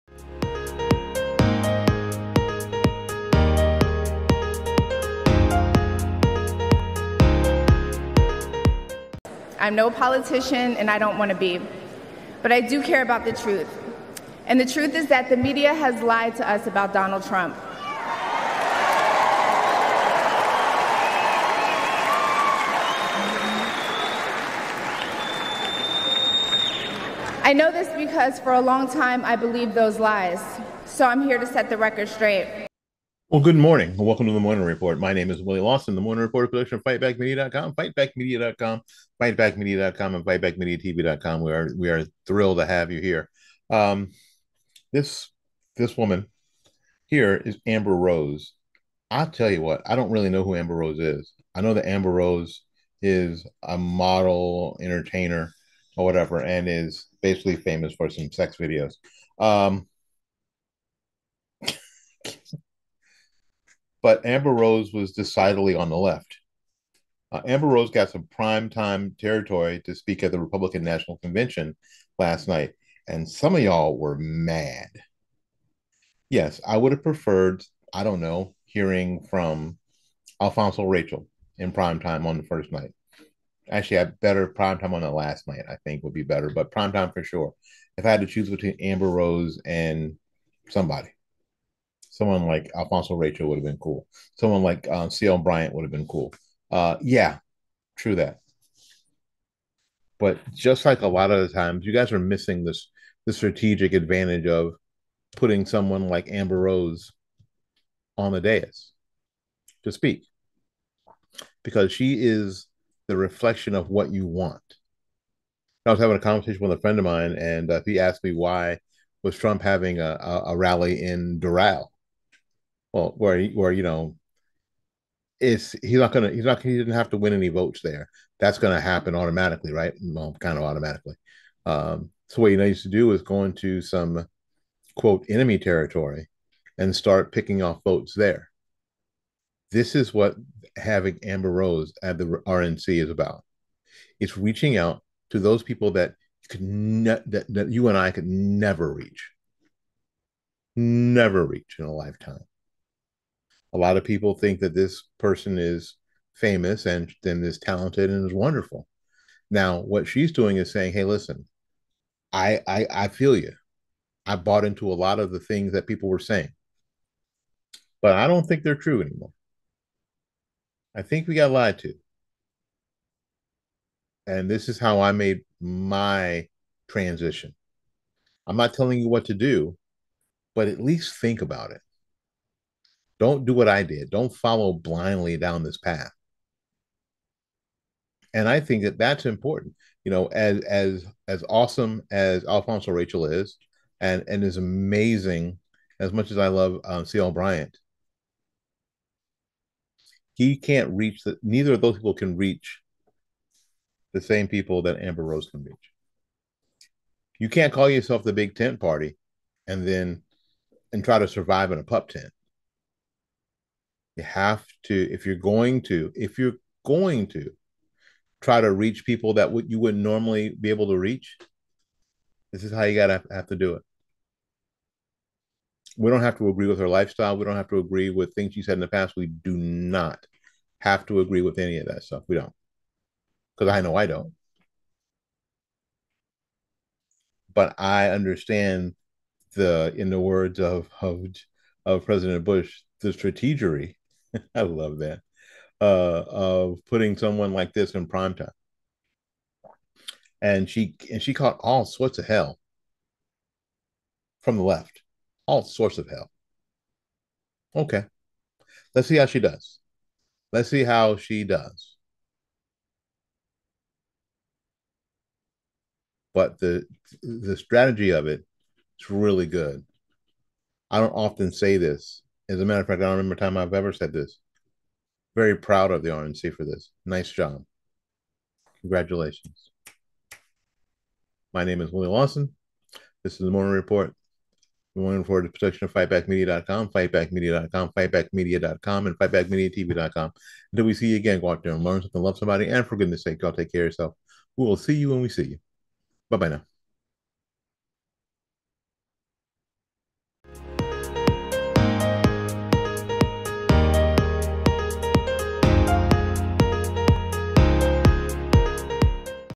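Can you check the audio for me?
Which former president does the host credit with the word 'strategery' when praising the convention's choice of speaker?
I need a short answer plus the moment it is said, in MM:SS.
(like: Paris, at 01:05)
President Bush, at 04:02.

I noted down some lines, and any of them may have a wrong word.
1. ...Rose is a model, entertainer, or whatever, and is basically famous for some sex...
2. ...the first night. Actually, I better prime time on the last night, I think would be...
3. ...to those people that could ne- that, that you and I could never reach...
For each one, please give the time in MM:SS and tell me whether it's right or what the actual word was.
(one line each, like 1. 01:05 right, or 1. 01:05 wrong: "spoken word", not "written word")
1. 00:52 right
2. 01:22 right
3. 02:25 right.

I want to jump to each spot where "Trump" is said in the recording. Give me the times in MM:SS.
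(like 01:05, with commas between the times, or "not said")
00:17, 01:59.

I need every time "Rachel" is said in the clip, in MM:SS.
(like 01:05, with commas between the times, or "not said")
01:20, 01:33, 03:12.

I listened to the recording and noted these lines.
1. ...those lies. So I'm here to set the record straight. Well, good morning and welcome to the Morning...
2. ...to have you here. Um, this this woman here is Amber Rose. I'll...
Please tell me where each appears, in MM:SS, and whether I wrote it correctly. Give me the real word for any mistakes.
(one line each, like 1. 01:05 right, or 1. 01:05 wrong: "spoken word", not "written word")
1. 00:29 right
2. 00:42 right.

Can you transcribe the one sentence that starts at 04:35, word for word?
Very proud of the RNC for this.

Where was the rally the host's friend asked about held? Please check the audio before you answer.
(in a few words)
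Doral.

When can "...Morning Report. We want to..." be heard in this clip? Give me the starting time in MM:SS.
04:43.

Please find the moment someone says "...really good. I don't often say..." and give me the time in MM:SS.
04:29.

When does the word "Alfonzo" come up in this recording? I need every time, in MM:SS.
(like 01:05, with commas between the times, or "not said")
01:20, 01:32, 03:12.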